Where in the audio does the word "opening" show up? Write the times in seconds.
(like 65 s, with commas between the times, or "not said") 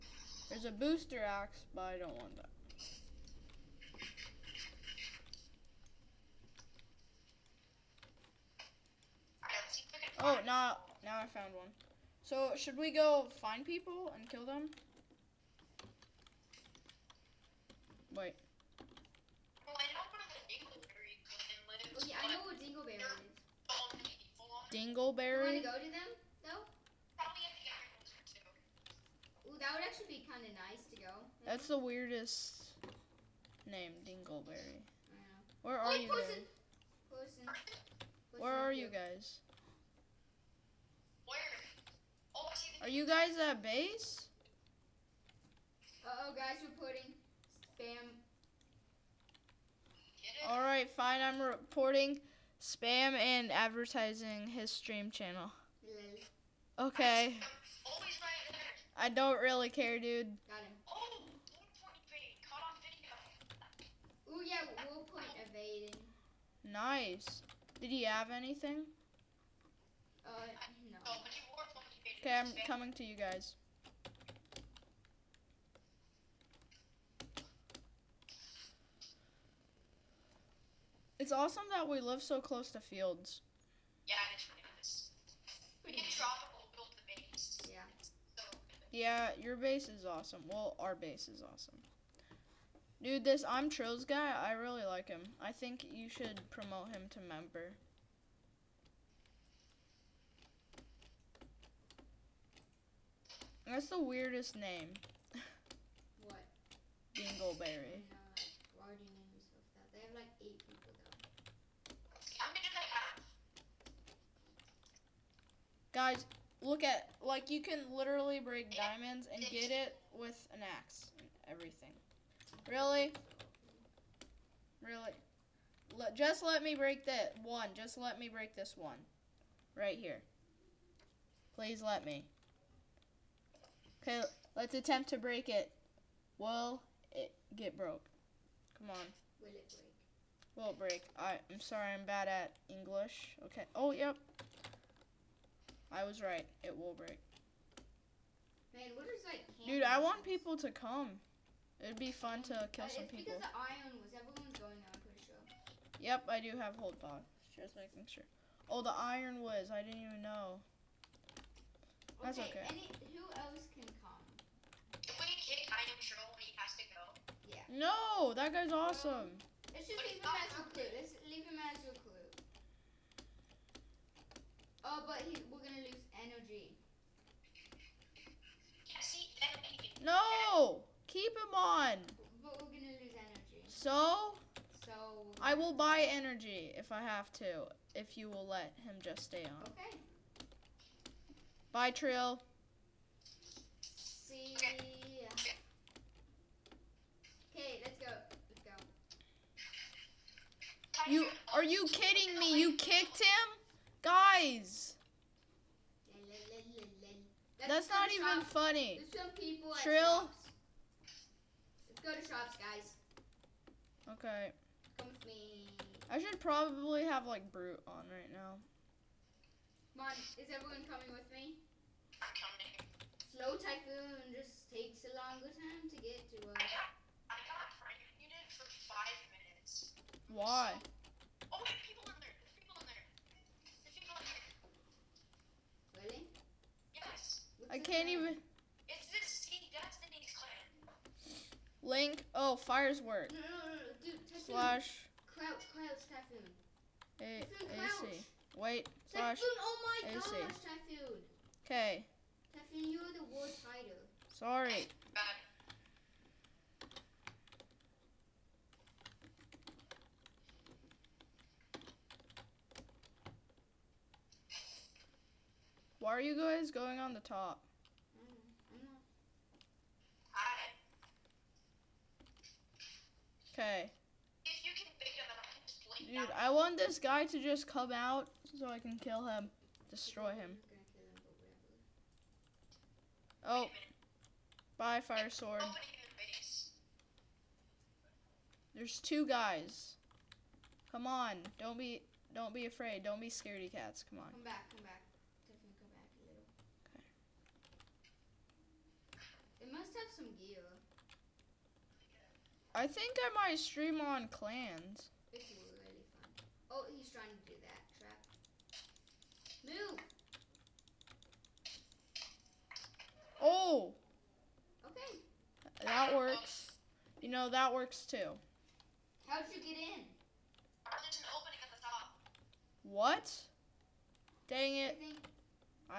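321 s.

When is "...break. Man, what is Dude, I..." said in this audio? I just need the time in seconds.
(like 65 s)
146 s.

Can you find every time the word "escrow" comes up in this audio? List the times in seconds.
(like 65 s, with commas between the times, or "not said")
not said.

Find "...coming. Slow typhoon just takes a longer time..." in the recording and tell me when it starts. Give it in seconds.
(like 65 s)
222 s.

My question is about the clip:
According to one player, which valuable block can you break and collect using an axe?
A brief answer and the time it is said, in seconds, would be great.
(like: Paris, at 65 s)
diamonds, at 118 s.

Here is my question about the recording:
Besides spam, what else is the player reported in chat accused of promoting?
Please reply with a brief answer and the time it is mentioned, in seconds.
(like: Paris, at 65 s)
his stream channel, at 54 s.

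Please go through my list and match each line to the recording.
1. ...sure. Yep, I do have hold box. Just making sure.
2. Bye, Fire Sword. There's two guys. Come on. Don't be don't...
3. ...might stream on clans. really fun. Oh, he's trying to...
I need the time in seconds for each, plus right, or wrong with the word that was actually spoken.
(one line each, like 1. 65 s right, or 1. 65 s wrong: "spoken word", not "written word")
1. 155 s right
2. 284 s right
3. 303 s right.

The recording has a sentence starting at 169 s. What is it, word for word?
Um, let's just leave him, as recruit.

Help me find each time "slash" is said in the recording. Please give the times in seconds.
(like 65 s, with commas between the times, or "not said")
244 s, 249 s.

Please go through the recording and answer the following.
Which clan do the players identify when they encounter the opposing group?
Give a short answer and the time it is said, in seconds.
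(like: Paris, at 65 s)
Seek Destiny's clan, at 239 s.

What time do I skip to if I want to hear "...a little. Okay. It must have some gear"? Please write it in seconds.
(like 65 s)
296 s.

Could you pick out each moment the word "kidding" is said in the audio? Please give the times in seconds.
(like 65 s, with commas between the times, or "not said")
201 s.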